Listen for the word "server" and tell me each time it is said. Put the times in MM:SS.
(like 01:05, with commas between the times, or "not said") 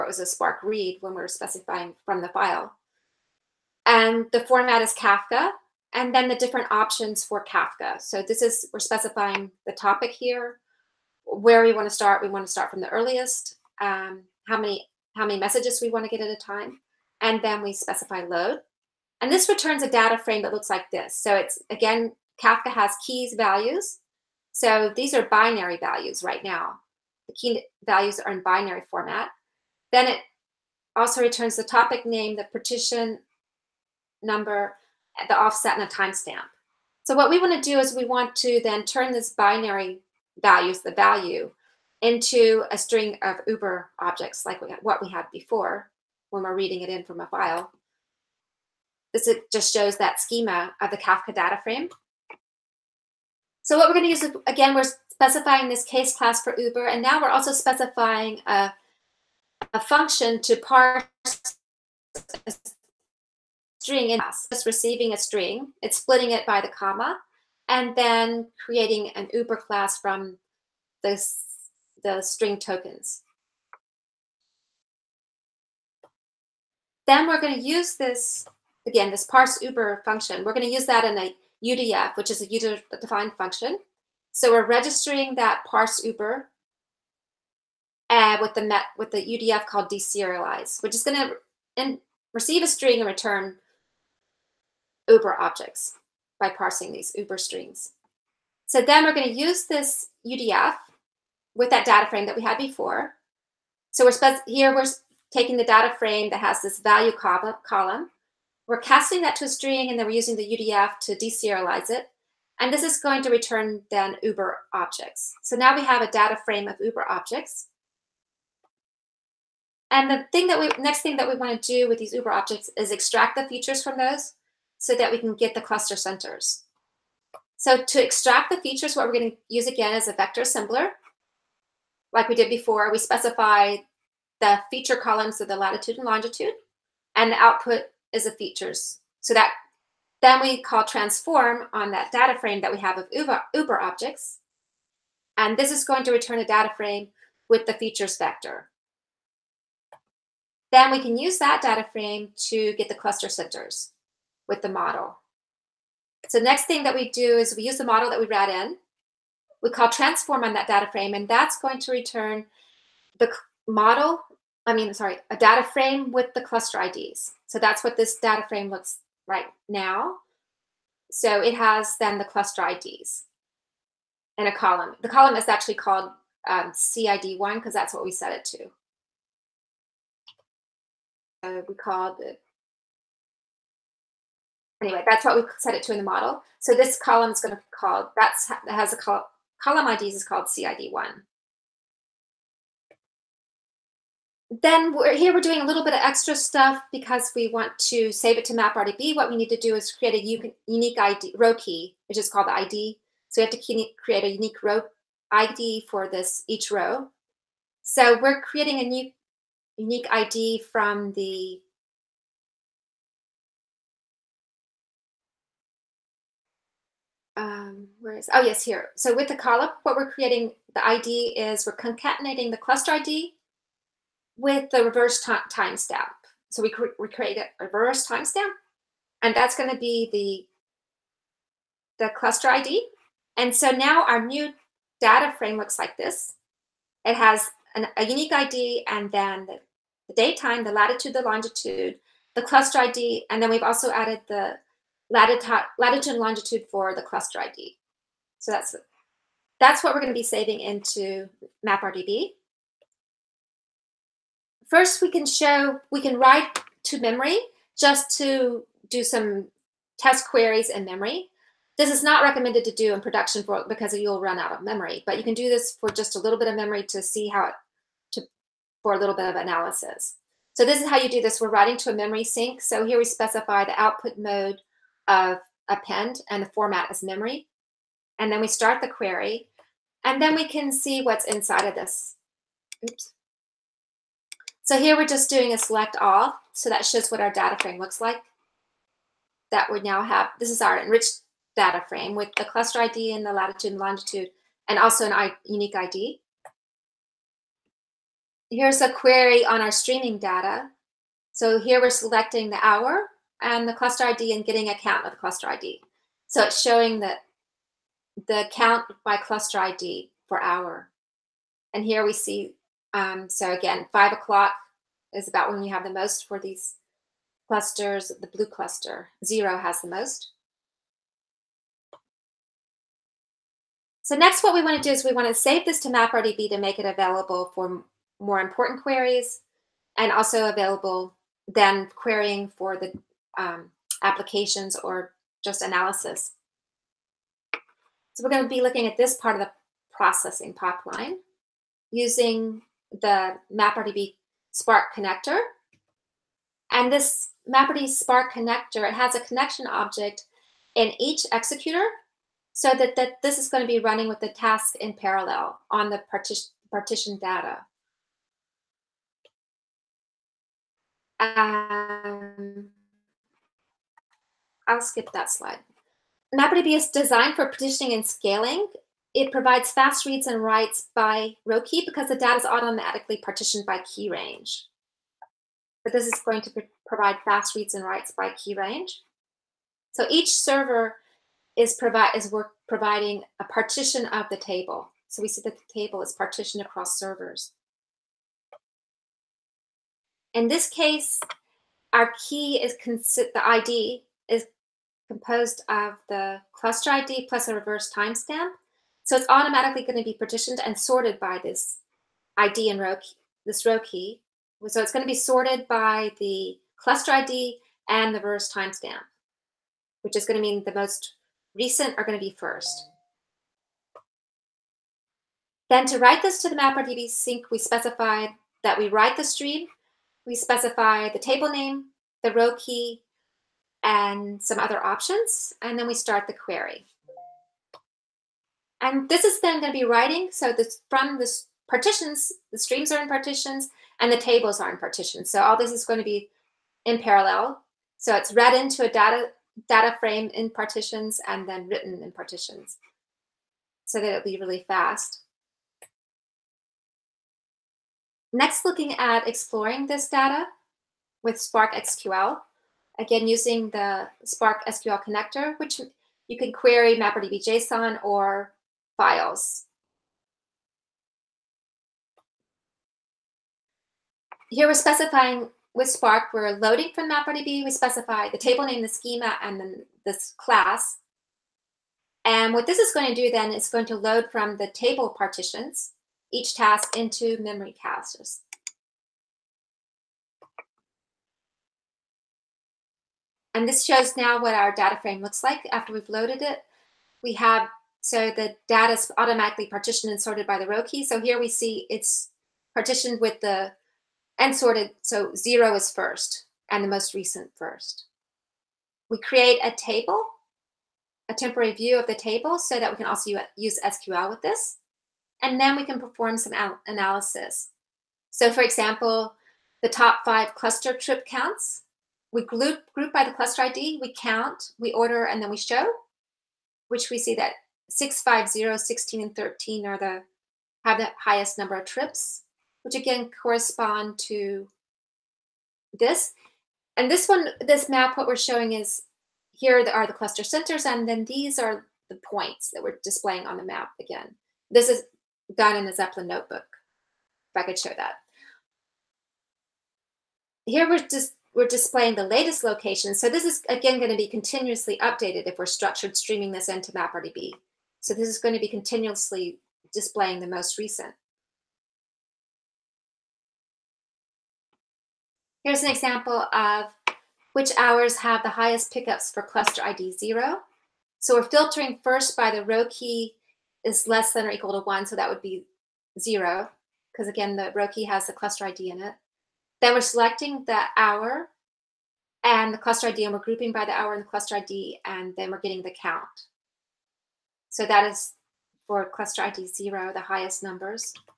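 06:20, 06:26.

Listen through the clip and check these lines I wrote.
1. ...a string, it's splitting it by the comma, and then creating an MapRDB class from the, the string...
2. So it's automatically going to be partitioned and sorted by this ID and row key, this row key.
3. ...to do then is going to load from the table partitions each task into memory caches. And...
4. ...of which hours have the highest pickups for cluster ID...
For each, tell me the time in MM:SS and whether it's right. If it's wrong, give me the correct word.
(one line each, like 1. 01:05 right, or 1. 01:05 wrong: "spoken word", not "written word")
1. 01:05 wrong: "Uber", not "MapRDB"
2. 06:39 right
3. 07:53 right
4. 09:16 right.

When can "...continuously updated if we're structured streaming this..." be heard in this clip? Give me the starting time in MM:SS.
09:04.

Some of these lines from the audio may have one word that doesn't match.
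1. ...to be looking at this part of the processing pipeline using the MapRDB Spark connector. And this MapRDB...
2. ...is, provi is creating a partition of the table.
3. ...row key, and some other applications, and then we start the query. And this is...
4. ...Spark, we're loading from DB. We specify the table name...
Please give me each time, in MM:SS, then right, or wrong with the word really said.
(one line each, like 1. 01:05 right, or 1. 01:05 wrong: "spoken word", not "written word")
1. 05:38 right
2. 06:21 wrong: "providing", not "creating"
3. 07:02 wrong: "options", not "applications"
4. 07:45 right.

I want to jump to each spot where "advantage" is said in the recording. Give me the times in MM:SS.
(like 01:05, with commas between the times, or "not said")
not said.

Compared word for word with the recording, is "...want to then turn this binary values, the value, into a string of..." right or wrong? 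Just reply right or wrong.
right.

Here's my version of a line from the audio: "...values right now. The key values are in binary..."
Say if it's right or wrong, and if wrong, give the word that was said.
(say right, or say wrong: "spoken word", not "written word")
right.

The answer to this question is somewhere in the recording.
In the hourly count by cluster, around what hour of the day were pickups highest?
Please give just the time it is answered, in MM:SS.
05:13.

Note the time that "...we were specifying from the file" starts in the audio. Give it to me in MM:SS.
00:01.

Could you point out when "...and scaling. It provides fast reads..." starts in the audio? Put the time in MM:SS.
06:07.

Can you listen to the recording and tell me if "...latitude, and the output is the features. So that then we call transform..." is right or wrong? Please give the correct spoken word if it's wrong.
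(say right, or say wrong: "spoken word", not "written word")
wrong: "longitude", not "latitude".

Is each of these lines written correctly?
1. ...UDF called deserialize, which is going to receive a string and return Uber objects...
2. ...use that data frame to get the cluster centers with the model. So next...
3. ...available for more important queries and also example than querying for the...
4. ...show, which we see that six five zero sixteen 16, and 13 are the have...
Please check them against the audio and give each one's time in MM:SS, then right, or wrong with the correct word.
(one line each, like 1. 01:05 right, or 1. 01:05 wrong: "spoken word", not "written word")
1. 01:29 right
2. 02:31 right
3. 05:26 wrong: "available", not "example"
4. 08:35 right.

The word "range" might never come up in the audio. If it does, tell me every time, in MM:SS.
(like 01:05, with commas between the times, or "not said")
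06:14, 06:18.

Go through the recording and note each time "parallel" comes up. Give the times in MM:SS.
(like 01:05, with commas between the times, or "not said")
05:54, 07:16.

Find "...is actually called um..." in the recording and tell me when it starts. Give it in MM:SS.
02:55.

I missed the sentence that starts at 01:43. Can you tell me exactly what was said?
So we're here we're taking the data frame that has this value col column.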